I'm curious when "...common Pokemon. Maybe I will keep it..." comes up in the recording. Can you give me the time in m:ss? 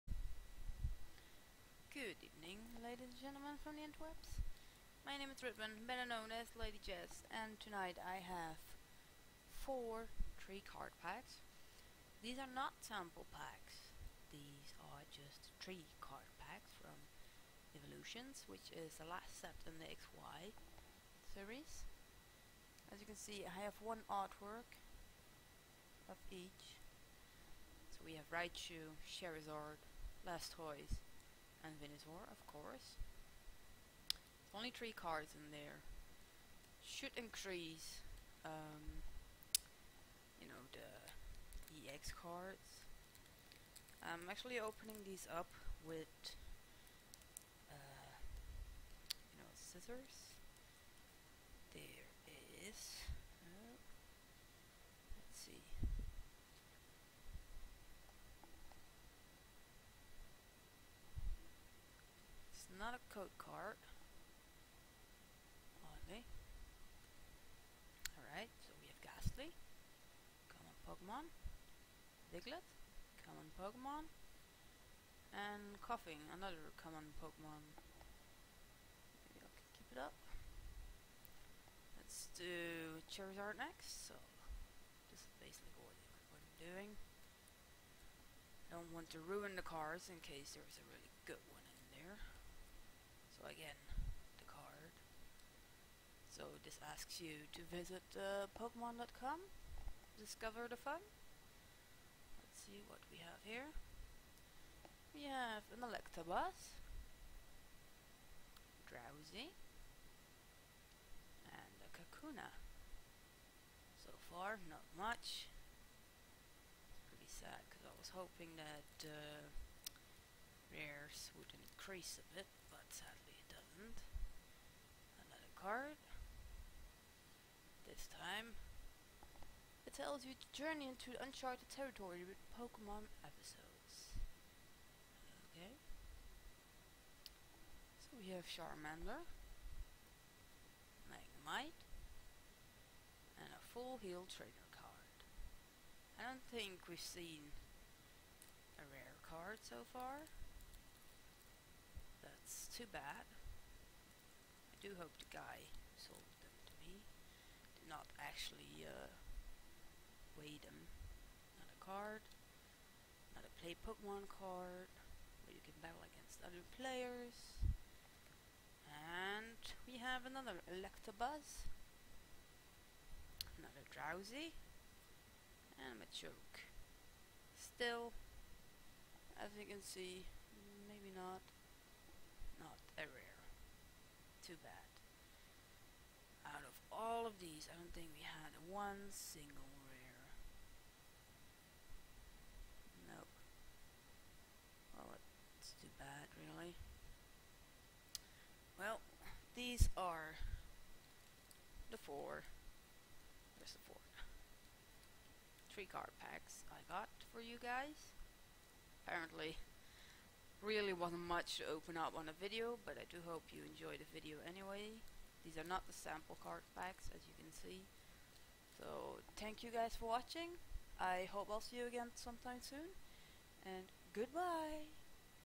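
1:16.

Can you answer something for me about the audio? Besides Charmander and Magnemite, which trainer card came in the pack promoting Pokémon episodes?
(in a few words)
full heal.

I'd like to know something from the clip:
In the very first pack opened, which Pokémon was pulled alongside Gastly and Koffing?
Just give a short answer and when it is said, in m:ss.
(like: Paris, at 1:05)
Diglett, at 1:12.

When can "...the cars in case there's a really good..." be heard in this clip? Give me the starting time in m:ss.
1:29.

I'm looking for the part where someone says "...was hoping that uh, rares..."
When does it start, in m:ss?
1:57.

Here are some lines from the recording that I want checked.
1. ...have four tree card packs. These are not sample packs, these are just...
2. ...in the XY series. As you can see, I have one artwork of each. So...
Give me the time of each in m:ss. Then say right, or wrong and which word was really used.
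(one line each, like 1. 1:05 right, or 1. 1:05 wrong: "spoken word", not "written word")
1. 0:08 right
2. 0:19 right.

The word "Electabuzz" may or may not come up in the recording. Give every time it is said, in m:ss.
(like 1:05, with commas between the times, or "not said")
1:45, 2:50.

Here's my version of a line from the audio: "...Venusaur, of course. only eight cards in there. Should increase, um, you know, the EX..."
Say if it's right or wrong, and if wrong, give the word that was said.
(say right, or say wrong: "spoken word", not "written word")
wrong: "three", not "eight".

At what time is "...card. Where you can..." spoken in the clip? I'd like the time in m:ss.
2:44.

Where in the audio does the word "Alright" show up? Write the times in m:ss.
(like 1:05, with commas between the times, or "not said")
1:08.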